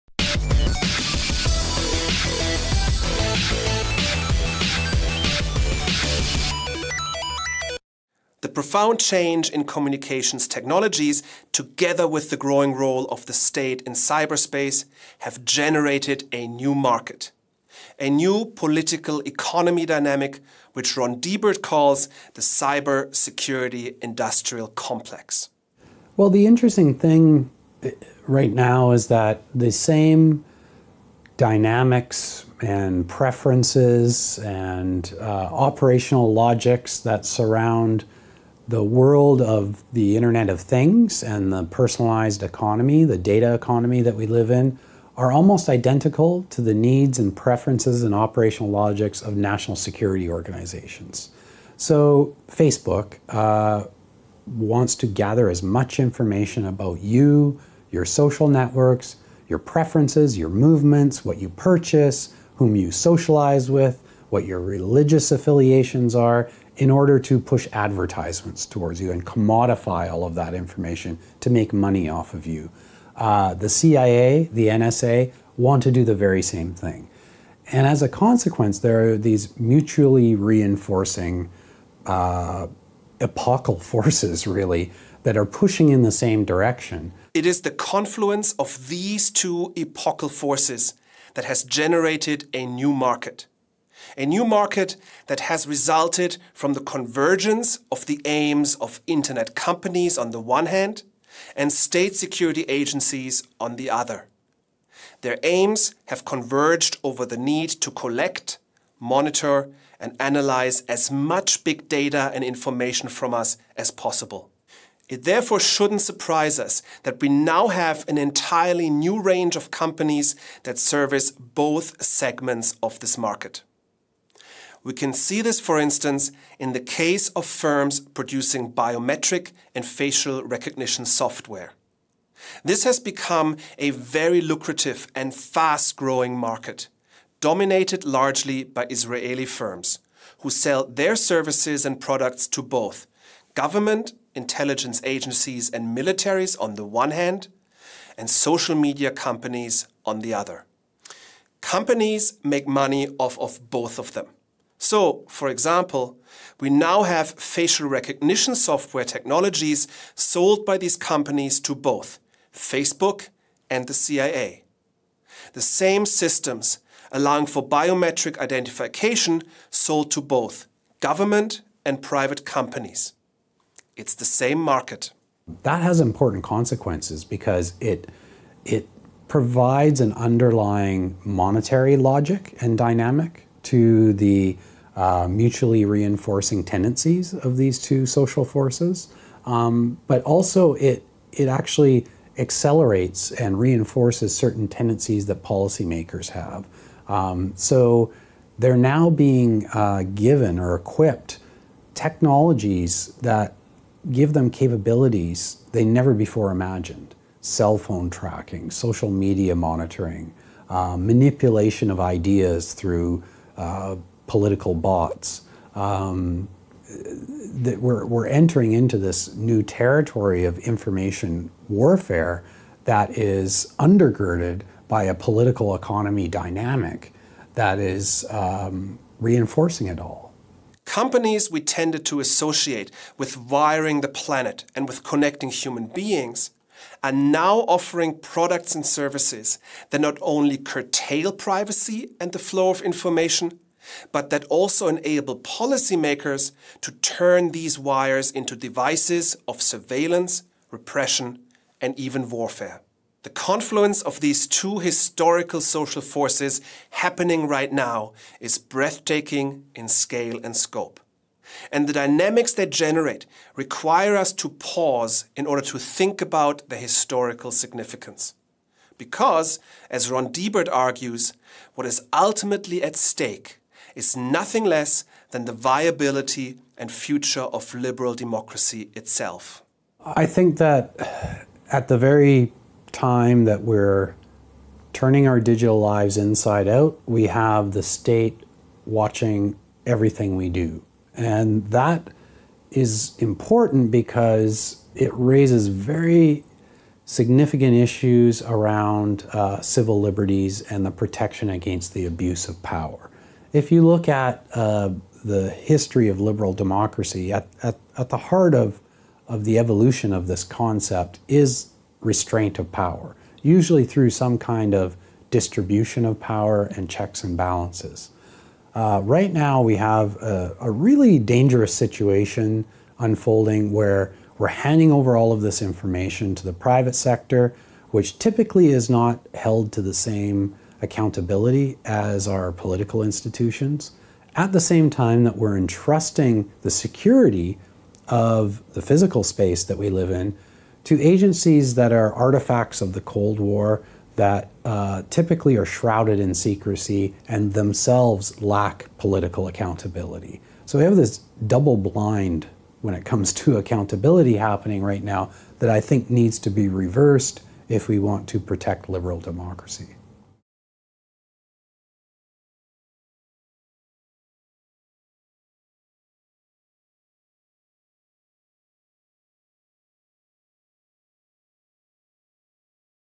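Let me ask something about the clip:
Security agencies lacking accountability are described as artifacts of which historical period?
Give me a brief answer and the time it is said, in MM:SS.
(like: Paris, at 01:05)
the Cold War, at 05:43.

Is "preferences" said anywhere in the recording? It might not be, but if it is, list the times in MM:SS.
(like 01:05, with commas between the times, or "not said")
00:33, 00:47, 00:59.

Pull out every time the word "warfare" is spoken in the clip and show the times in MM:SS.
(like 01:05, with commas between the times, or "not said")
03:41, 04:12.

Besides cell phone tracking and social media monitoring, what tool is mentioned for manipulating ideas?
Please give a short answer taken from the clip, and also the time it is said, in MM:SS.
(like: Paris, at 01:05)
political bots, at 03:34.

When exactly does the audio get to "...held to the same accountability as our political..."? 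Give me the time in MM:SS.
05:29.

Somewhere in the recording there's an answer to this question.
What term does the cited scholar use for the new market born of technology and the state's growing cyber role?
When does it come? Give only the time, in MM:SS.
00:22.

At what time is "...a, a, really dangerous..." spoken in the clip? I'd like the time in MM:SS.
05:20.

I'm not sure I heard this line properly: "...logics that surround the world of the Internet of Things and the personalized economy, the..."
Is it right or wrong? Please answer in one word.
right.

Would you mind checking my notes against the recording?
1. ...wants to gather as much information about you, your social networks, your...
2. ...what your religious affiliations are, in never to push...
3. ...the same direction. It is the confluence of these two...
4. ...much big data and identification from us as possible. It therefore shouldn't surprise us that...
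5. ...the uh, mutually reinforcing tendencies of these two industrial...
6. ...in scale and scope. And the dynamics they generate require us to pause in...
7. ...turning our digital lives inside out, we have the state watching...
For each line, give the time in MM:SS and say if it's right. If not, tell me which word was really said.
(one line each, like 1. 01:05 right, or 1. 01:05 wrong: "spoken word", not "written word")
1. 00:54 right
2. 01:04 wrong: "order", not "never"
3. 01:26 right
4. 01:51 wrong: "information", not "identification"
5. 03:04 wrong: "social", not "industrial"
6. 04:19 right
7. 04:44 right.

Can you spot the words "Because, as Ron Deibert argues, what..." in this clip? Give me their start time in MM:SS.
04:28.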